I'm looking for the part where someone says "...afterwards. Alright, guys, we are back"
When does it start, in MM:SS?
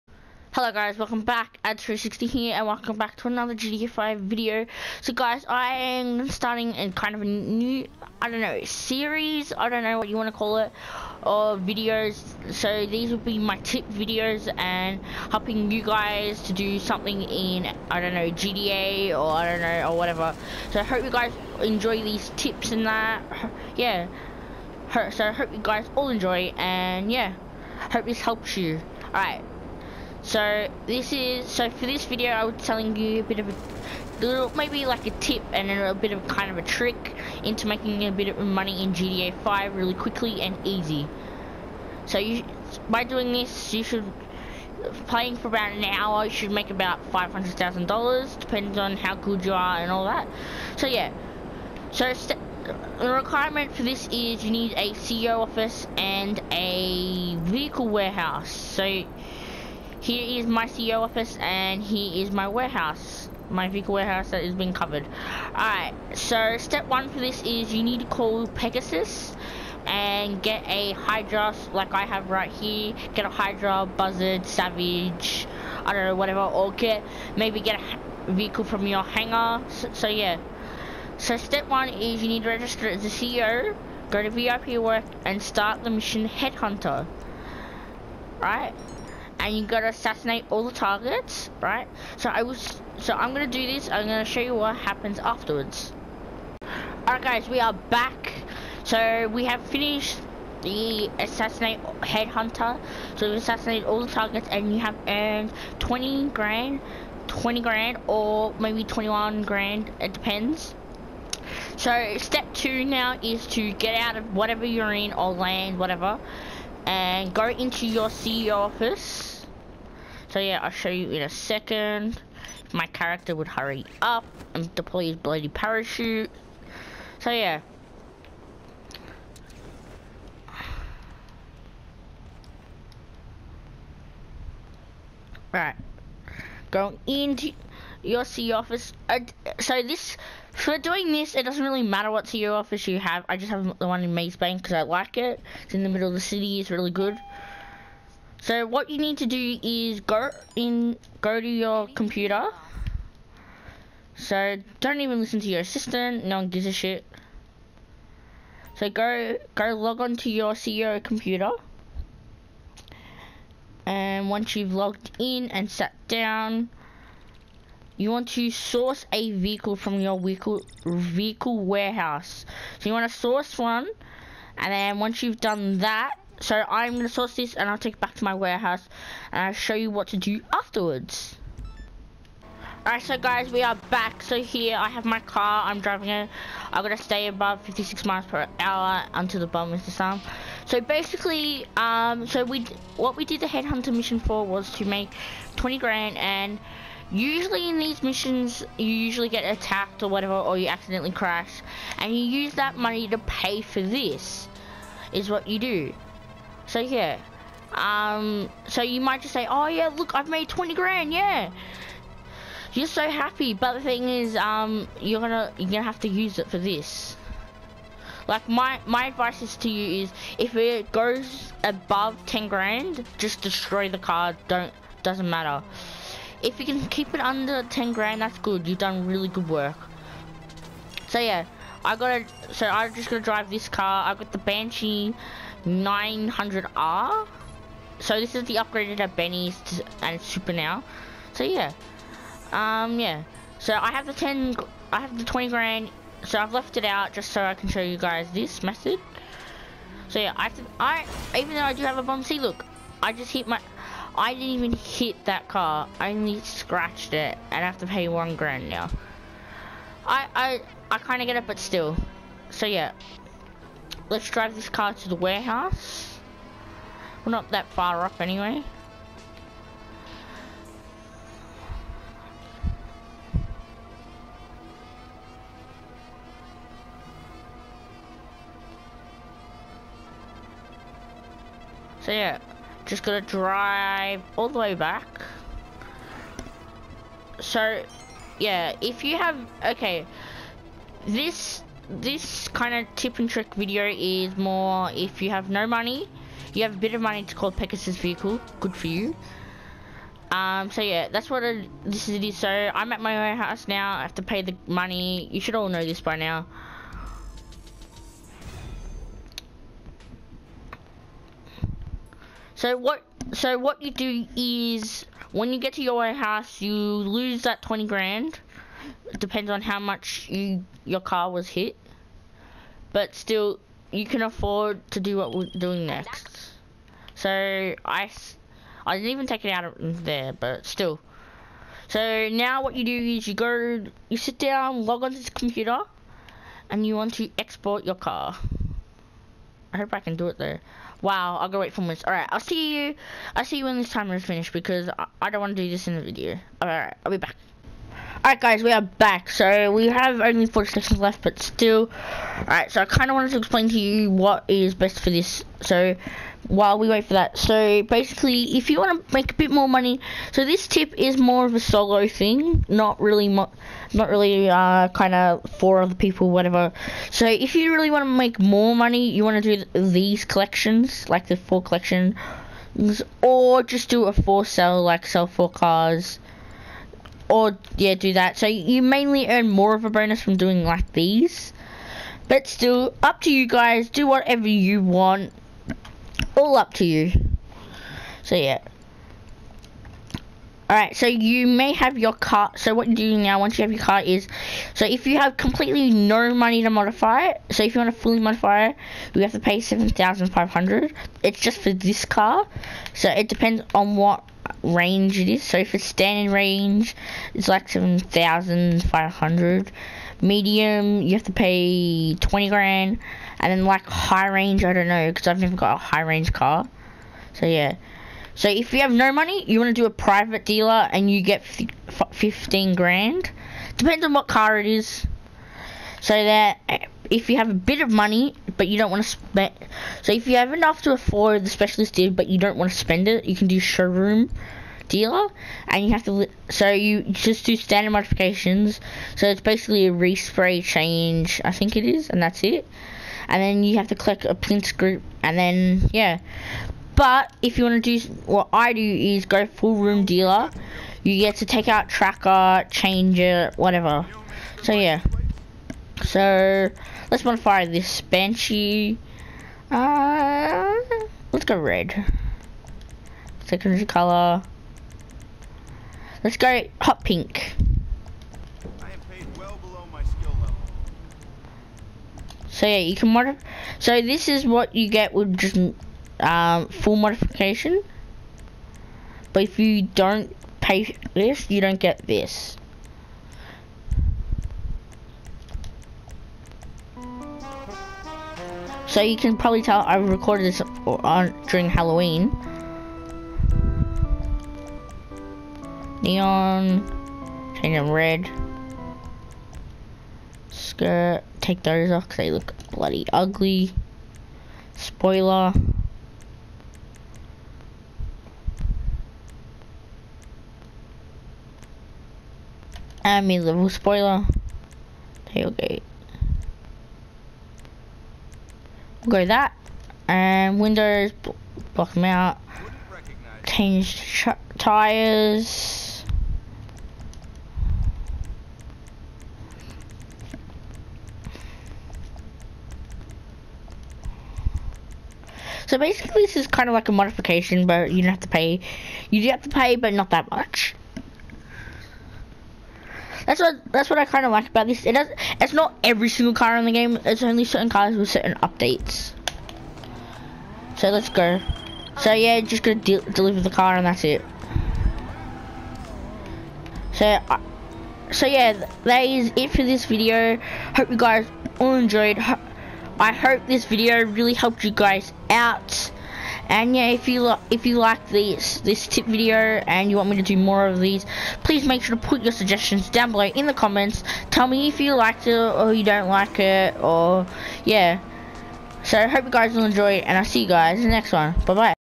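01:35.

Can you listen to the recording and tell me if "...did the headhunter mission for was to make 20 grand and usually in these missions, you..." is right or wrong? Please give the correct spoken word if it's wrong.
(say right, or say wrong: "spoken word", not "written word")
right.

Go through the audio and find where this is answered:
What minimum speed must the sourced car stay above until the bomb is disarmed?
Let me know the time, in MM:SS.
03:07.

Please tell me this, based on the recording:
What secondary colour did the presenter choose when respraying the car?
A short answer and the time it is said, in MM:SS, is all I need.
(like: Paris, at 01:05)
Hot pink, at 07:46.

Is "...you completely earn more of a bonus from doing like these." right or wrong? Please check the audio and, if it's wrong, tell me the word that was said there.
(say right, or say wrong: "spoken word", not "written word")
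wrong: "mainly", not "completely".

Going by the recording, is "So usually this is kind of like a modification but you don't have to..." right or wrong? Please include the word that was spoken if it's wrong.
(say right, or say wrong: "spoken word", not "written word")
wrong: "basically", not "usually".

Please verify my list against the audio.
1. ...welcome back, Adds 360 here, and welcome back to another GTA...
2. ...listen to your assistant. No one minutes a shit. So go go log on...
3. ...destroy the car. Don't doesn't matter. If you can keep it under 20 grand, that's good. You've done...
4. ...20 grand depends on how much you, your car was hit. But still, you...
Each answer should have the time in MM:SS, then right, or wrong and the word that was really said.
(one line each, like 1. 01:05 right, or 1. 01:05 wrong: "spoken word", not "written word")
1. 00:00 right
2. 02:35 wrong: "gives", not "minutes"
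3. 03:43 wrong: "10", not "20"
4. 05:17 right.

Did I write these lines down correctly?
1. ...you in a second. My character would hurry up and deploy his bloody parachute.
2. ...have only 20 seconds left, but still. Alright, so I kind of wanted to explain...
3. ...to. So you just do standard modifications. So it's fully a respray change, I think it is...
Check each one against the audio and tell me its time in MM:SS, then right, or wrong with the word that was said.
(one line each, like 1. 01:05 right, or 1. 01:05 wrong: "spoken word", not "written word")
1. 02:00 right
2. 05:49 wrong: "40", not "20"
3. 07:16 wrong: "basically", not "fully".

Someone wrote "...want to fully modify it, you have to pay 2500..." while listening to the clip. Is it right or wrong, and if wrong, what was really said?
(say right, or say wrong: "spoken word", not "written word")
wrong: "7500", not "2500".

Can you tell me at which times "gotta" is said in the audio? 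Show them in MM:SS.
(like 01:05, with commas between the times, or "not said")
01:29, 03:51.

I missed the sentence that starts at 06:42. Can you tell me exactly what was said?
So it depends on what range it is.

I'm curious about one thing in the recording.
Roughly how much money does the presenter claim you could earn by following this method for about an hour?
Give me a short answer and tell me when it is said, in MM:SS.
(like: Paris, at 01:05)
$500,000, at 00:47.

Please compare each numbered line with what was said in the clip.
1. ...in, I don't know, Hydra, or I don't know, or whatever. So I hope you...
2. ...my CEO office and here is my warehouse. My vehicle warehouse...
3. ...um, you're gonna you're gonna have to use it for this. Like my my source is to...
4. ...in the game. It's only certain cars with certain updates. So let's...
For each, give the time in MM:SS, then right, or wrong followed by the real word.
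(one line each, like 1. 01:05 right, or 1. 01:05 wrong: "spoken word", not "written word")
1. 00:17 wrong: "GTA", not "Hydra"
2. 01:00 right
3. 03:34 wrong: "advice", not "source"
4. 09:06 right.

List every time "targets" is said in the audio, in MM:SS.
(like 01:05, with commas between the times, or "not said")
01:30, 01:44.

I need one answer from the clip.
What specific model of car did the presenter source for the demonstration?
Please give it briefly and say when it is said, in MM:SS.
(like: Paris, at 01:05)
Banshee 900R, at 03:54.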